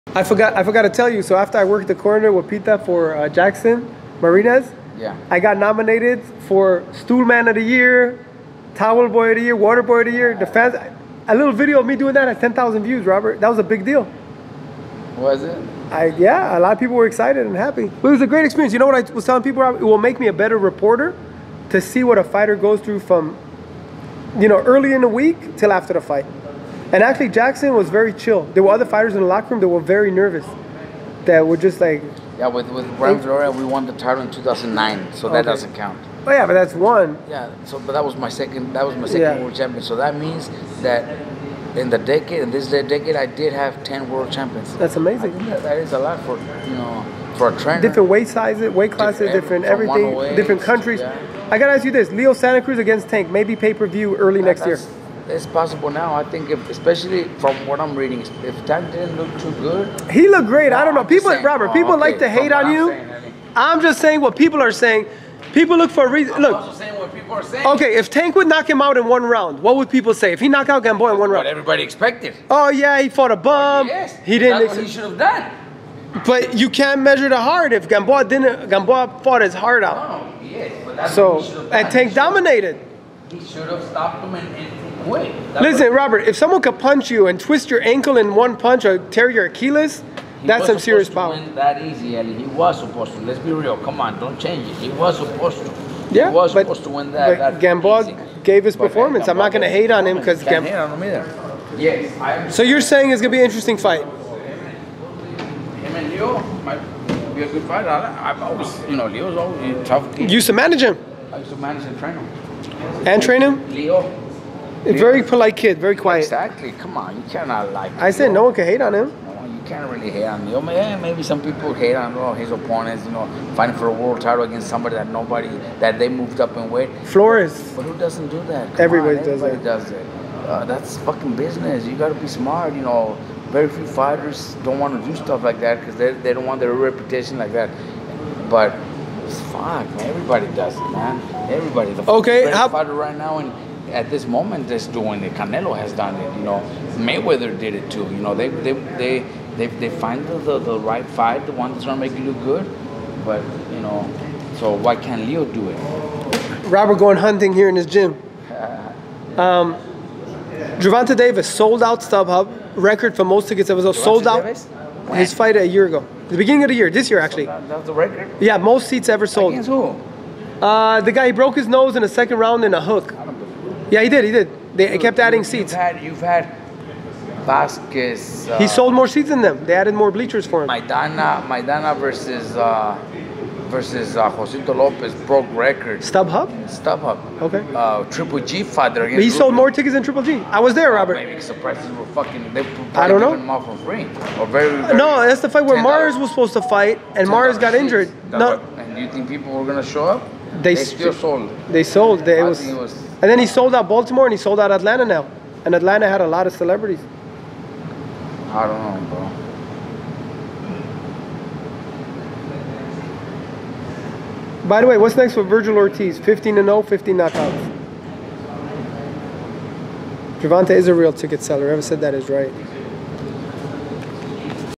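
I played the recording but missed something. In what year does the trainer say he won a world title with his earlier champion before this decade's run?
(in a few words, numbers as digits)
2009.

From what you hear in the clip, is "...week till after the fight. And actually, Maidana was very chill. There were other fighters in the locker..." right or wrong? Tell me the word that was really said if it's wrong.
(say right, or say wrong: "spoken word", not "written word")
wrong: "Jackson", not "Maidana".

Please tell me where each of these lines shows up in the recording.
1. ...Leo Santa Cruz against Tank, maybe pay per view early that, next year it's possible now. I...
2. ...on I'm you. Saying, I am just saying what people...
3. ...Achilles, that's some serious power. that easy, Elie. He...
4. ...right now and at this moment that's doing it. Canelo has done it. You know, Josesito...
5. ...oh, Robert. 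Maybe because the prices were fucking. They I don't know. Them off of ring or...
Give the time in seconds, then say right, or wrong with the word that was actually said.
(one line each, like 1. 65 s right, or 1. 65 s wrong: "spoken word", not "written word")
1. 52 s right
2. 62 s right
3. 89 s right
4. 142 s wrong: "Mayweather", not "Josesito"
5. 190 s right.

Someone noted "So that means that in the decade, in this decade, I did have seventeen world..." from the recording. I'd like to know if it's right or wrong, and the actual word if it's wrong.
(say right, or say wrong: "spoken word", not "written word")
wrong: "ten", not "seventeen".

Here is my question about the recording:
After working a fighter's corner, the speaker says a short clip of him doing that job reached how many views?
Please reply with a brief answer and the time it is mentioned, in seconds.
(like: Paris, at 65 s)
10,000, at 12 s.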